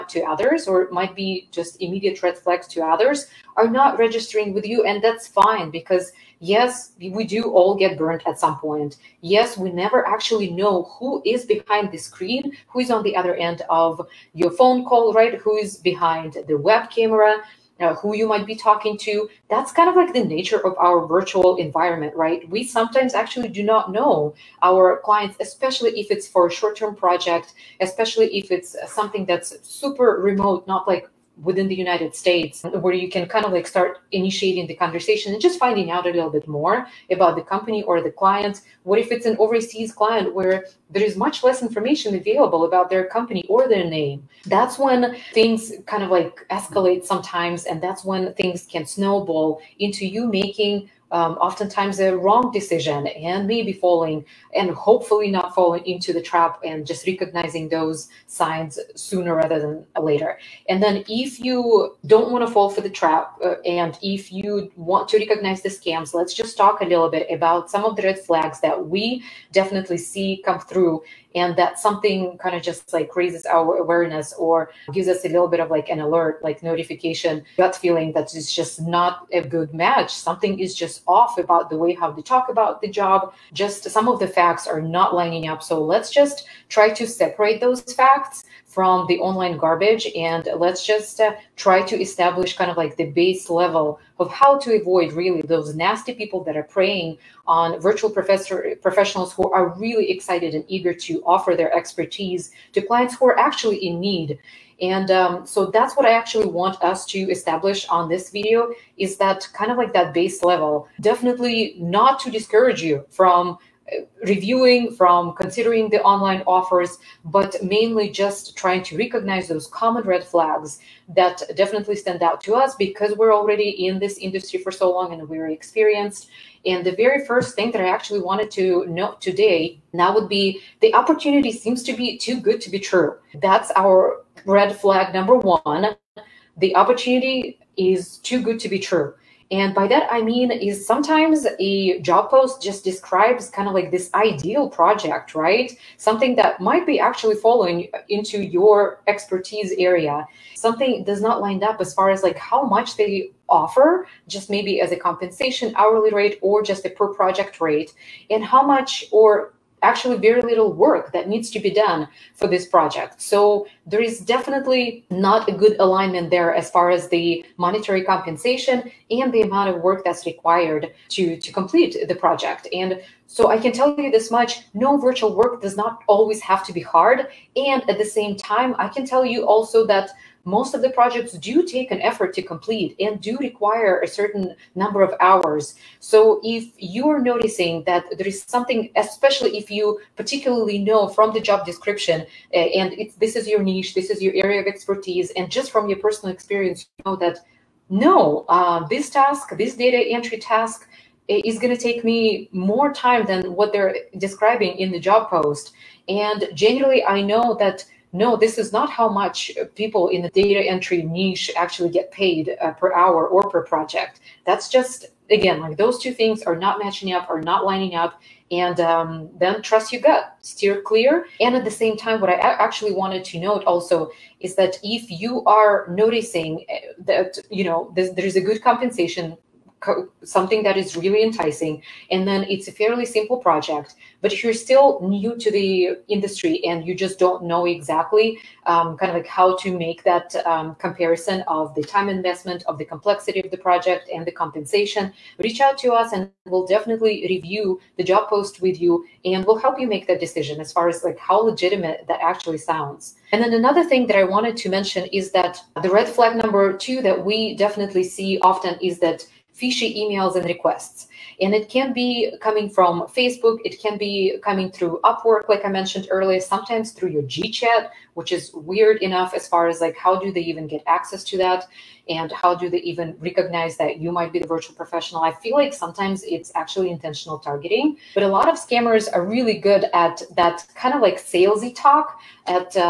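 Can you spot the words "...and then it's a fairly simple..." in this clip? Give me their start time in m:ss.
3:52.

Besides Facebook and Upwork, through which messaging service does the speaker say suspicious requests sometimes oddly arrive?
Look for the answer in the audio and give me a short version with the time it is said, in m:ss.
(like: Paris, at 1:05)
GChat, at 4:27.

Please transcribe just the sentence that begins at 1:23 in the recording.
Just some of the facts are not lining up.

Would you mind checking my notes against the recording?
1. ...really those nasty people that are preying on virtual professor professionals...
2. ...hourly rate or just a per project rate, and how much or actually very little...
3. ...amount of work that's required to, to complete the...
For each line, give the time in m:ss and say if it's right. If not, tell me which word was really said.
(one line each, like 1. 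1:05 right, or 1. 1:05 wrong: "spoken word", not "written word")
1. 1:35 right
2. 2:35 right
3. 2:49 right.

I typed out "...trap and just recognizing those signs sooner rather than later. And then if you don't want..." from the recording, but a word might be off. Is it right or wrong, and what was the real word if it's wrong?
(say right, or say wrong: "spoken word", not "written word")
right.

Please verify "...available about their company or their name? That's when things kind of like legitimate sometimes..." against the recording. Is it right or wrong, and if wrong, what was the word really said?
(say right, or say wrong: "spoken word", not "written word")
wrong: "escalate", not "legitimate".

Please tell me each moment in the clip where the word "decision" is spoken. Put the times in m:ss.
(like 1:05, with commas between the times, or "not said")
0:52, 4:10.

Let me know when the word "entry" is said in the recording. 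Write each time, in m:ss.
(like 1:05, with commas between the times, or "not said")
3:19, 3:30.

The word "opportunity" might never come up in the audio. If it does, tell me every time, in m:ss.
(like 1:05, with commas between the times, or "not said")
2:10, 2:16.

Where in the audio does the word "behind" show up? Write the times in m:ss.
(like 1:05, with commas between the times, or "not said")
0:11, 0:15.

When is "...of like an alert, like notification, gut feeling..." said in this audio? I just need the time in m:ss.
1:15.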